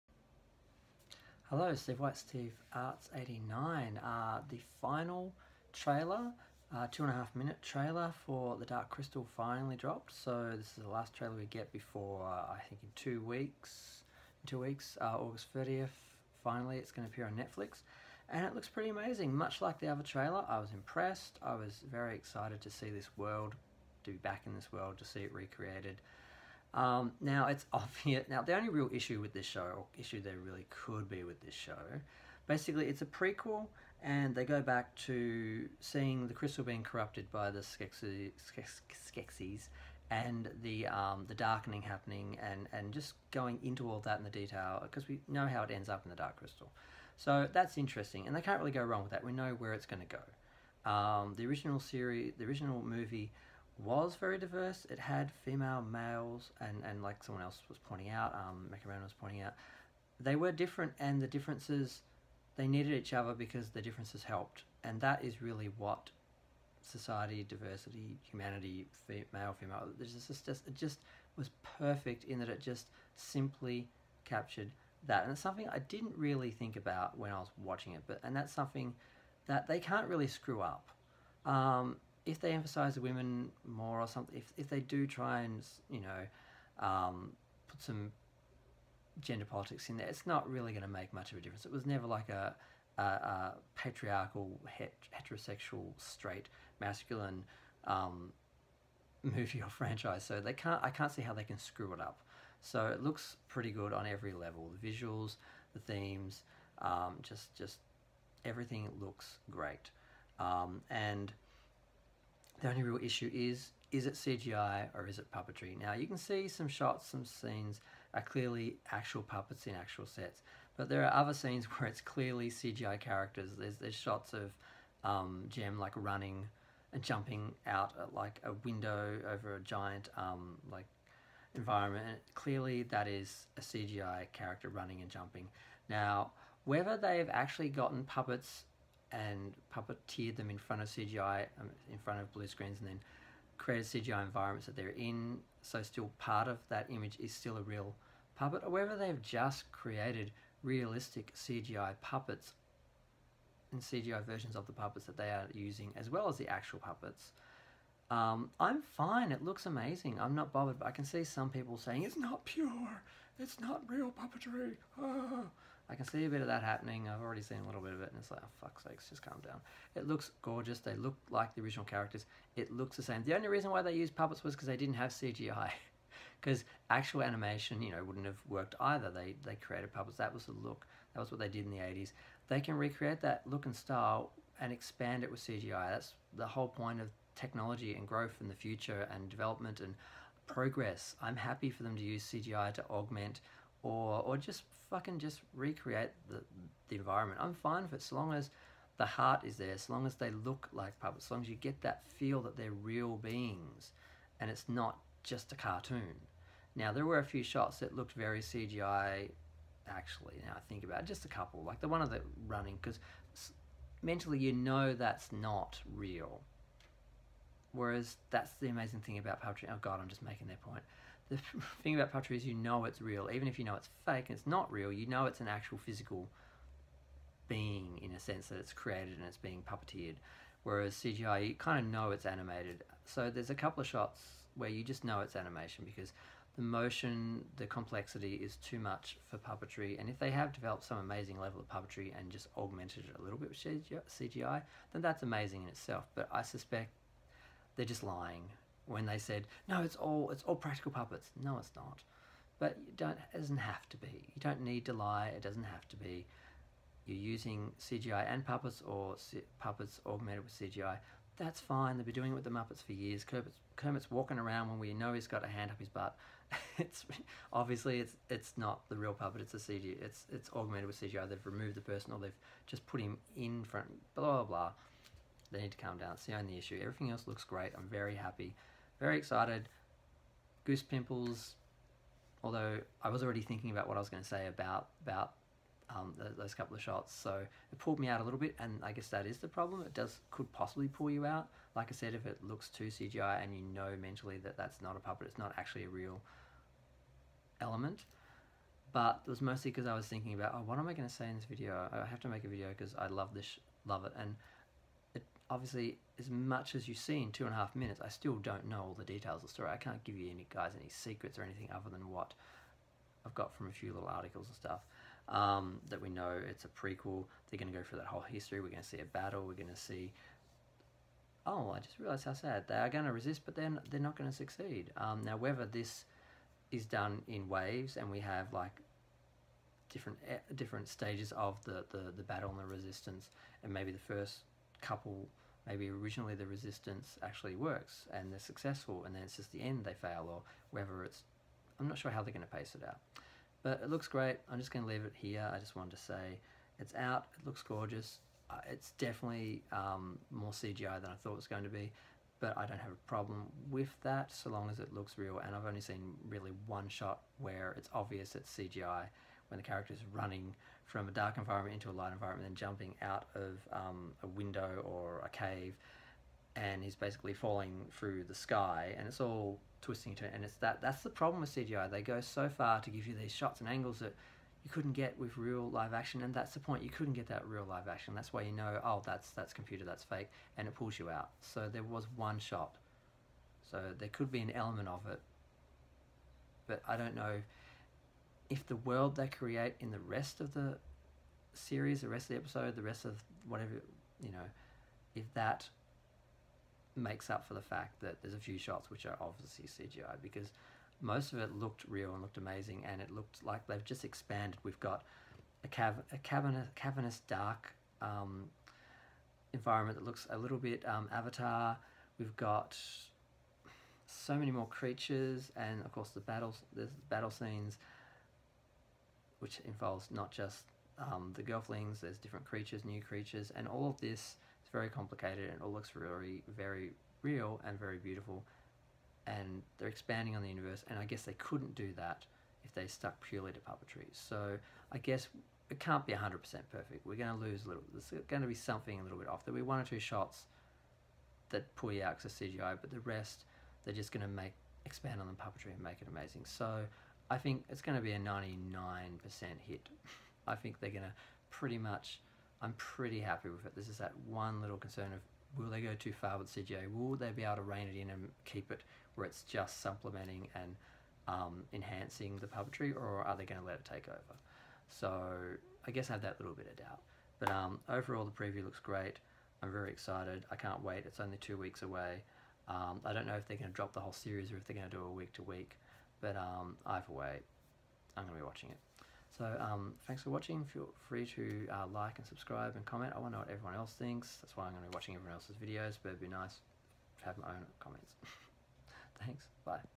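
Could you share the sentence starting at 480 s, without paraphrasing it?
Feel free to uh, like and subscribe and comment.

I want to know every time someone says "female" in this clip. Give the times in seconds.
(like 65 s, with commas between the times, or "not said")
55 s, 69 s.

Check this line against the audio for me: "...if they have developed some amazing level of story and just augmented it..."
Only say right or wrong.
wrong.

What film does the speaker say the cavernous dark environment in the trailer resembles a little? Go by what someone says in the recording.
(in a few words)
Avatar.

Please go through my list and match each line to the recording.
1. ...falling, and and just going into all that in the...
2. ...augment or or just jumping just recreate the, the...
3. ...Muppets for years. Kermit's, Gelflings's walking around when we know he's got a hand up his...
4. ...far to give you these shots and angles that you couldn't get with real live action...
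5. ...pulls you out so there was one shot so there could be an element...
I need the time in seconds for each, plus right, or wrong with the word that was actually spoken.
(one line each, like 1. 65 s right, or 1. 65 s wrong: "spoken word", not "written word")
1. 41 s wrong: "happening", not "falling"
2. 192 s wrong: "fucking", not "jumping"
3. 262 s wrong: "Kermit", not "Gelflings"
4. 372 s right
5. 380 s right.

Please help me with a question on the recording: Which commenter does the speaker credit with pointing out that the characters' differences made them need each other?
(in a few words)
Mechaman.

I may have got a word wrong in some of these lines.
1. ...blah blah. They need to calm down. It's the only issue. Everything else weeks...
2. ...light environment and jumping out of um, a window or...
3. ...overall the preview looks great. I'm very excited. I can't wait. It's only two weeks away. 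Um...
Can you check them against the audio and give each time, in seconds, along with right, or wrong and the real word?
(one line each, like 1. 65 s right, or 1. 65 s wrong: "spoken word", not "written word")
1. 274 s wrong: "looks", not "weeks"
2. 361 s right
3. 467 s right.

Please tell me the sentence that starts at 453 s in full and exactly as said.
This is that one little concern of will they go too far with CGI?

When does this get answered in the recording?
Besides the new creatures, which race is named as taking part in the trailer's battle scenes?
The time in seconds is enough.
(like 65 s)
421 s.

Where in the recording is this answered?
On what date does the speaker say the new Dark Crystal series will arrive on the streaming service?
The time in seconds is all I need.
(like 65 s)
15 s.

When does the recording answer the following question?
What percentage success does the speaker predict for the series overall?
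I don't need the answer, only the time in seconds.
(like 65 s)
448 s.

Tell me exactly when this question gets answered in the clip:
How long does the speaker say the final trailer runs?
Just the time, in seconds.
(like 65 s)
6 s.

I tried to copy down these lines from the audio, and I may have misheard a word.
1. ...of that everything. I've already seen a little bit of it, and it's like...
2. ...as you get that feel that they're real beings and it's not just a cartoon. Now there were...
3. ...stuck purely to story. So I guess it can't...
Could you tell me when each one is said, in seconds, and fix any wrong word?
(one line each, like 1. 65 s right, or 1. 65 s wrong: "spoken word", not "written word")
1. 166 s wrong: "happening", not "everything"
2. 201 s right
3. 432 s wrong: "puppetry", not "story".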